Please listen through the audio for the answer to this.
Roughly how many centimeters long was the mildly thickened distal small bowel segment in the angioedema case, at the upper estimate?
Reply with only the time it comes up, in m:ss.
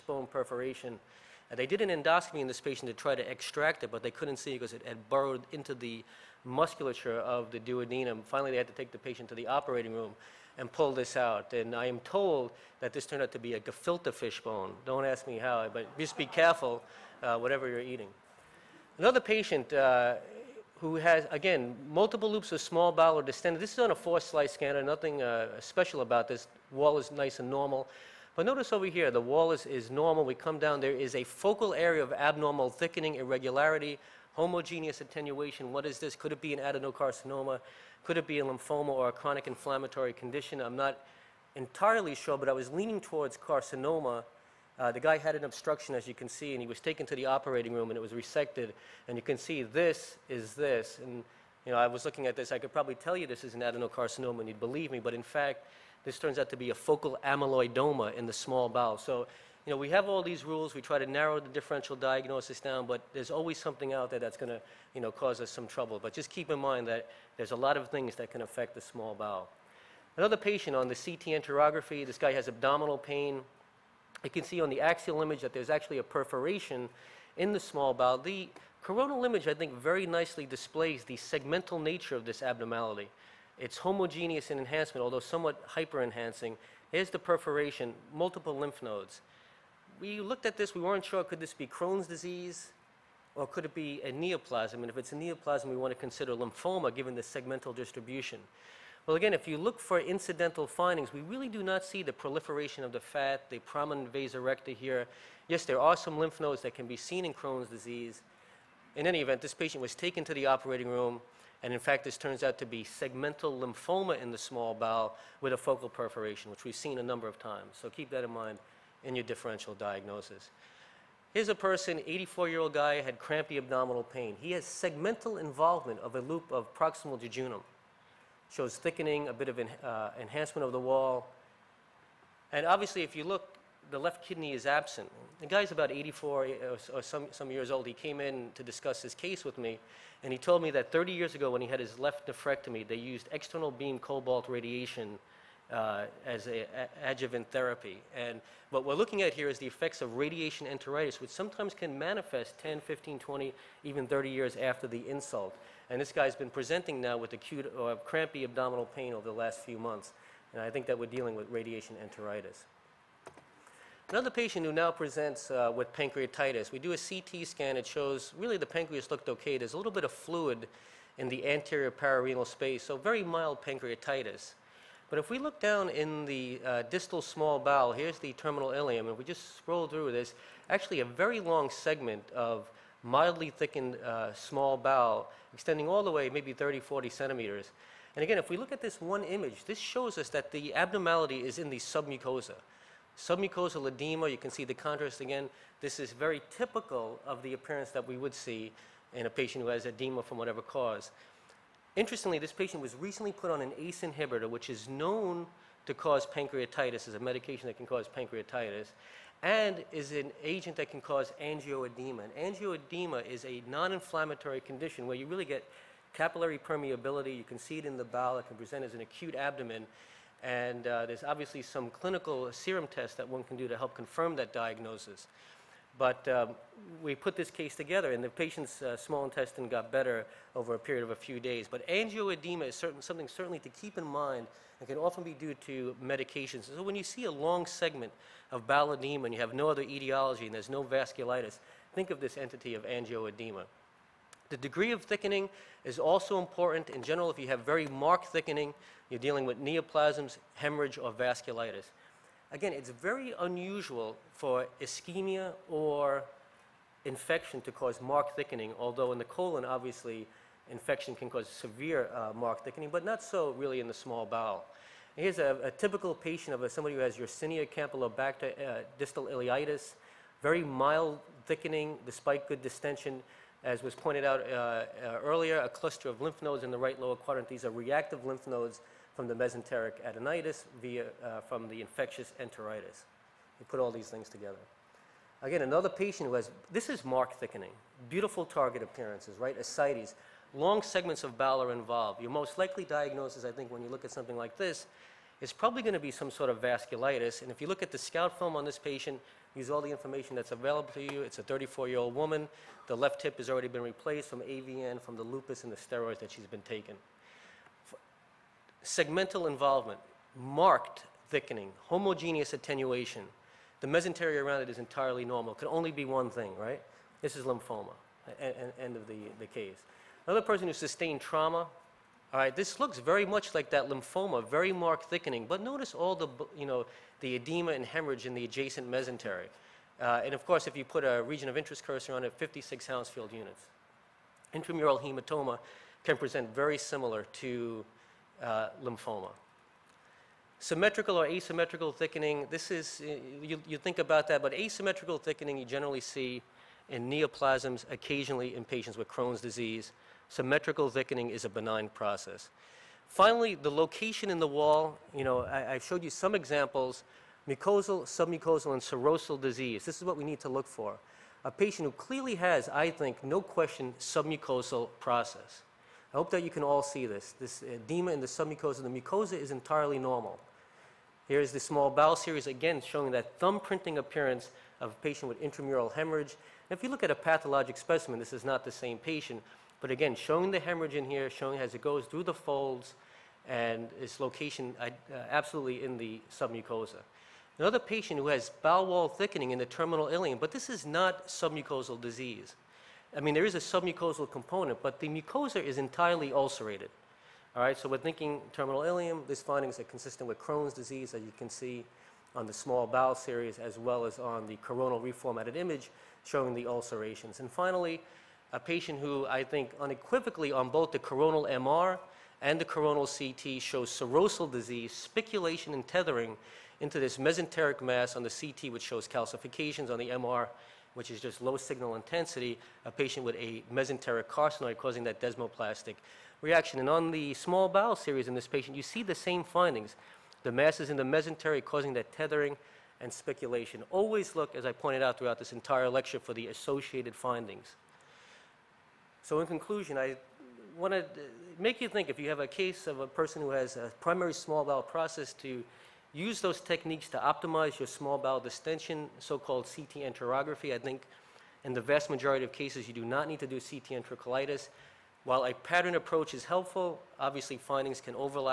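3:06.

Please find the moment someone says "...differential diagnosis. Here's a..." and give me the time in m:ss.
1:59.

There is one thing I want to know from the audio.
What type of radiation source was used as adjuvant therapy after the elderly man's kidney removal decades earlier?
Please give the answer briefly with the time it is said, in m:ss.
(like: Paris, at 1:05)
External beam cobalt, at 2:23.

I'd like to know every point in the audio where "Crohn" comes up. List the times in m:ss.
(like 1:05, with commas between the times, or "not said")
1:31, 1:47, 5:49, 6:40.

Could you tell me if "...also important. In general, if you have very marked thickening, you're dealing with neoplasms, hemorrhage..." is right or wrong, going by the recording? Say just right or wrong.
right.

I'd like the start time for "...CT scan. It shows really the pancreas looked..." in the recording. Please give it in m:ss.
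2:46.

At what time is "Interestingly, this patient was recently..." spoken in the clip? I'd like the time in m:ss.
3:21.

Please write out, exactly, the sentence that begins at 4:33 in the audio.
As was pointed out uh, uh earlier, a cluster of lymph nodes in the right lower quadrant.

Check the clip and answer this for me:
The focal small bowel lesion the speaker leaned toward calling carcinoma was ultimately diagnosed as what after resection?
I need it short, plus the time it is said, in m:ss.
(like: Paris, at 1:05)
Focal amyloidoma, at 0:56.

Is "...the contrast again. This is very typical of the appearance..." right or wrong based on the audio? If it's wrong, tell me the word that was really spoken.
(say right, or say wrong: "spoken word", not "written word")
right.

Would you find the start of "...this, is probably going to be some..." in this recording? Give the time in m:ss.
4:54.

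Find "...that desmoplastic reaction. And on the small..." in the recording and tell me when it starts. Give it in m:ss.
7:05.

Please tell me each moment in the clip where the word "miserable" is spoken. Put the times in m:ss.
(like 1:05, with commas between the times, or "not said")
not said.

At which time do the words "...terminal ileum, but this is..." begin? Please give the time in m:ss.
6:29.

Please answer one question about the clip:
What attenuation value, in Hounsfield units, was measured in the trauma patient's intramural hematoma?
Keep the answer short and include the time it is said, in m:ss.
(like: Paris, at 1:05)
56, at 5:32.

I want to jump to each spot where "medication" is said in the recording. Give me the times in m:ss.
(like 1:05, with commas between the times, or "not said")
3:27, 3:56.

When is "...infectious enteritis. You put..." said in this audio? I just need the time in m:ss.
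4:41.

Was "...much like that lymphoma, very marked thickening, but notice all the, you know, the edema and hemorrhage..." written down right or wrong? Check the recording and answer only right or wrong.
right.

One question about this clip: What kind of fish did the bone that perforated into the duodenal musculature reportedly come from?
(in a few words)
Gefilte fish.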